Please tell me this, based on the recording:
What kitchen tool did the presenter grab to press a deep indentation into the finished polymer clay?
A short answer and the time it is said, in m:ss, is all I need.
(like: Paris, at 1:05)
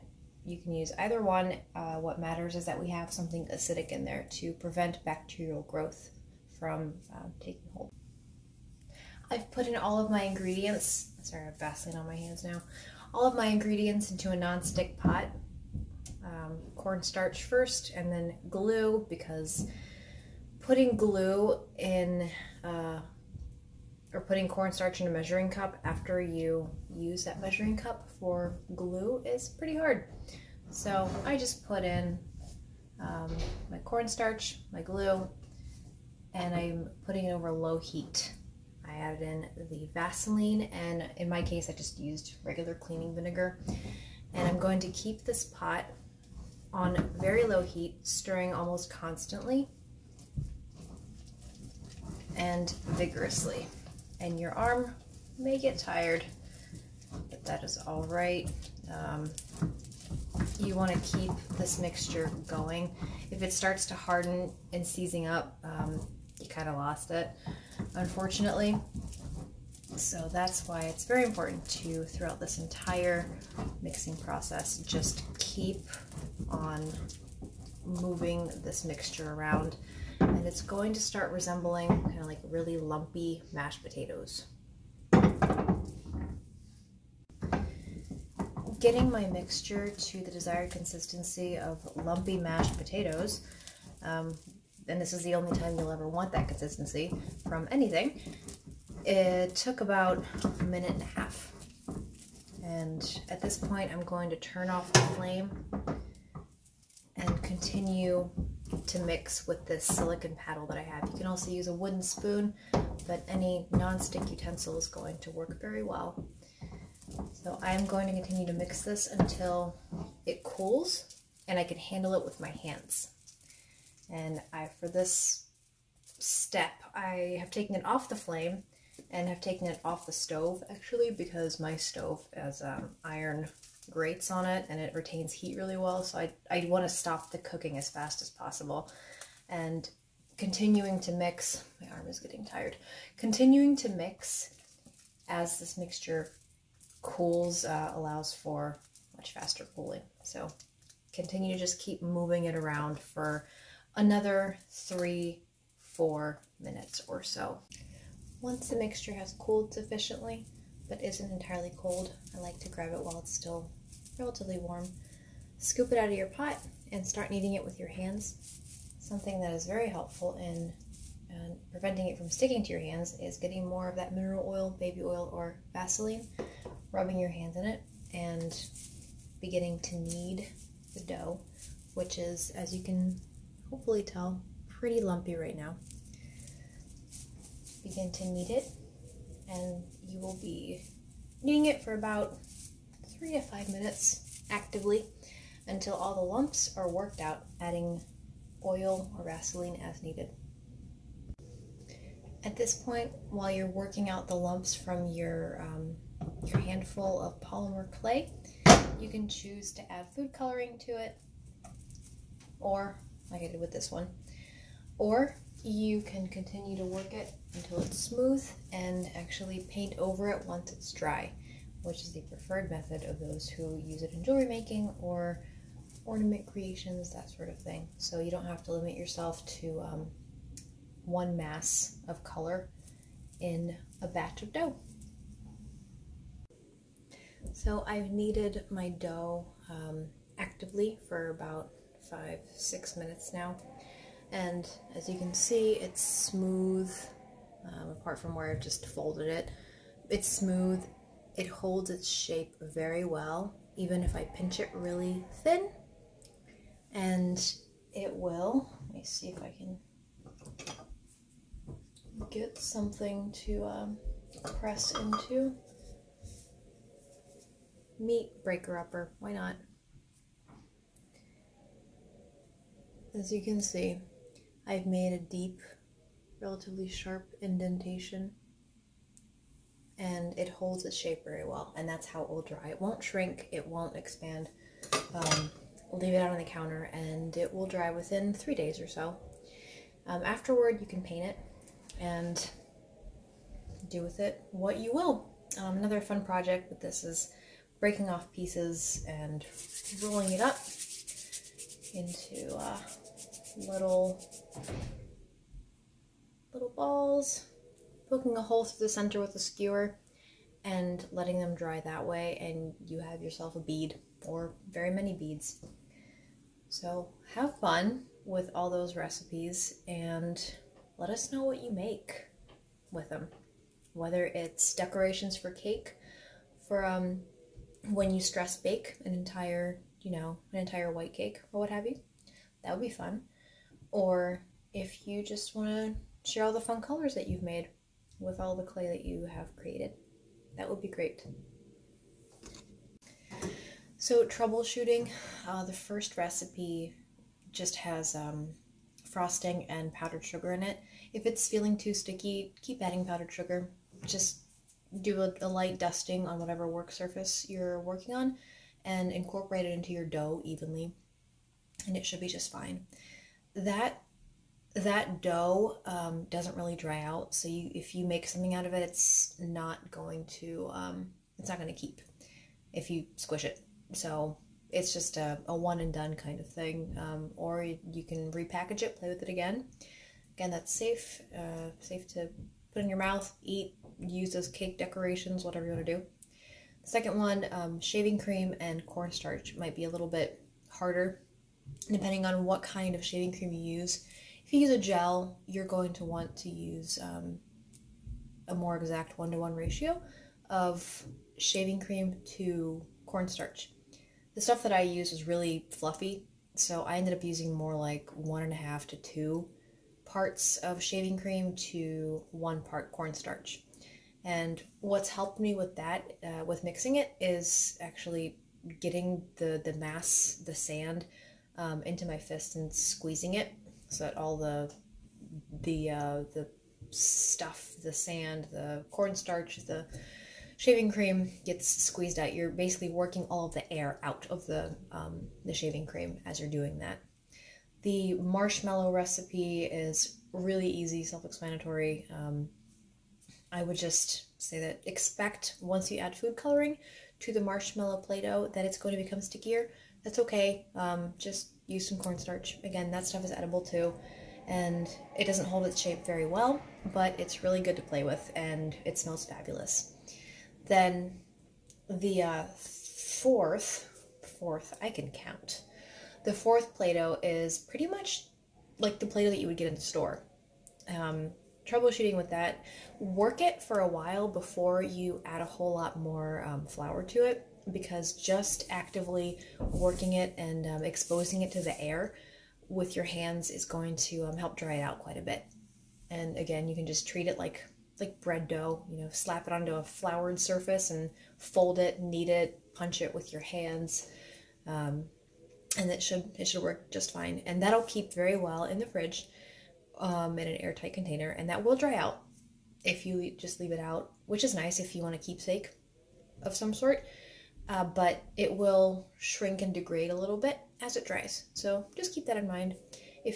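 Meat breaker upper, at 4:27.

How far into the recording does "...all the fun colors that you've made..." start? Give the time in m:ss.
5:36.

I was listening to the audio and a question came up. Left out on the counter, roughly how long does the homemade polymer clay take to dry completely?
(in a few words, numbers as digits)
About 3 days.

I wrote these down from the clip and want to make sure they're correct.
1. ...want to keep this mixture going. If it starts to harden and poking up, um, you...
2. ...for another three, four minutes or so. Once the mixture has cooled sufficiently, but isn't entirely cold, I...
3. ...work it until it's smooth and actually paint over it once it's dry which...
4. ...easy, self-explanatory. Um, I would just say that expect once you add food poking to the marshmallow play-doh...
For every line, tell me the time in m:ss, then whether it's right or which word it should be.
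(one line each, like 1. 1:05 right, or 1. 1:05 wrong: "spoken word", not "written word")
1. 1:00 wrong: "seizing", not "poking"
2. 2:32 right
3. 3:36 right
4. 7:20 wrong: "coloring", not "poking".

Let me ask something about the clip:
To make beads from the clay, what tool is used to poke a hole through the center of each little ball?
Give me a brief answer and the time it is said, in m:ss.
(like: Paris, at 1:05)
A skewer, at 5:09.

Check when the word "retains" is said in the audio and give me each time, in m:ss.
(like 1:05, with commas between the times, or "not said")
2:14.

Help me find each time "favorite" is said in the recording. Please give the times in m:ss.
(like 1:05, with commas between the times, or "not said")
not said.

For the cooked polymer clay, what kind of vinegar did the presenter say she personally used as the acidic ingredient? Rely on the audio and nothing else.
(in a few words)
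cleaning vinegar.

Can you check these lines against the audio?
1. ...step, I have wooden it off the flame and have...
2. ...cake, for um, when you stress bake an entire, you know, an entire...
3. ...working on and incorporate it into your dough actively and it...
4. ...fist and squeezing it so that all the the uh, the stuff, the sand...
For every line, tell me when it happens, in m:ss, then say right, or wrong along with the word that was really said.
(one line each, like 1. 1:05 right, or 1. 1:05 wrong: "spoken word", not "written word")
1. 2:06 wrong: "taken", not "wooden"
2. 5:25 right
3. 5:57 wrong: "evenly", not "actively"
4. 7:02 right.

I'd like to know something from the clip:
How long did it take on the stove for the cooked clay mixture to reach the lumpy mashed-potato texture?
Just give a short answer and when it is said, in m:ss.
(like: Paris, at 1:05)
About a minute and a half, at 1:39.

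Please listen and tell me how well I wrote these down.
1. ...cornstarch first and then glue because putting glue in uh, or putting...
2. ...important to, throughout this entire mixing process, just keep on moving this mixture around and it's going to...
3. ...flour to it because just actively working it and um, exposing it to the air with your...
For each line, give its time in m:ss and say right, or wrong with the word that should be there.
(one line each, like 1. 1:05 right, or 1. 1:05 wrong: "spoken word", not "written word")
1. 0:16 right
2. 1:11 right
3. 7:56 right.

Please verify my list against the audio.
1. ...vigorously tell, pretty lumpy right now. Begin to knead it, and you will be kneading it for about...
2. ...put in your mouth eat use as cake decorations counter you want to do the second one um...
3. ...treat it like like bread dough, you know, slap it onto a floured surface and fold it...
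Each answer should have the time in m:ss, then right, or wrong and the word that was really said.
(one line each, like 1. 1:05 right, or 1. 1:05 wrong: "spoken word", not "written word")
1. 3:03 wrong: "hopefully", not "vigorously"
2. 6:22 wrong: "whatever", not "counter"
3. 8:07 right.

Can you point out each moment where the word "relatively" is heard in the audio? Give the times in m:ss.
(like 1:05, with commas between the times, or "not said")
2:44, 4:36.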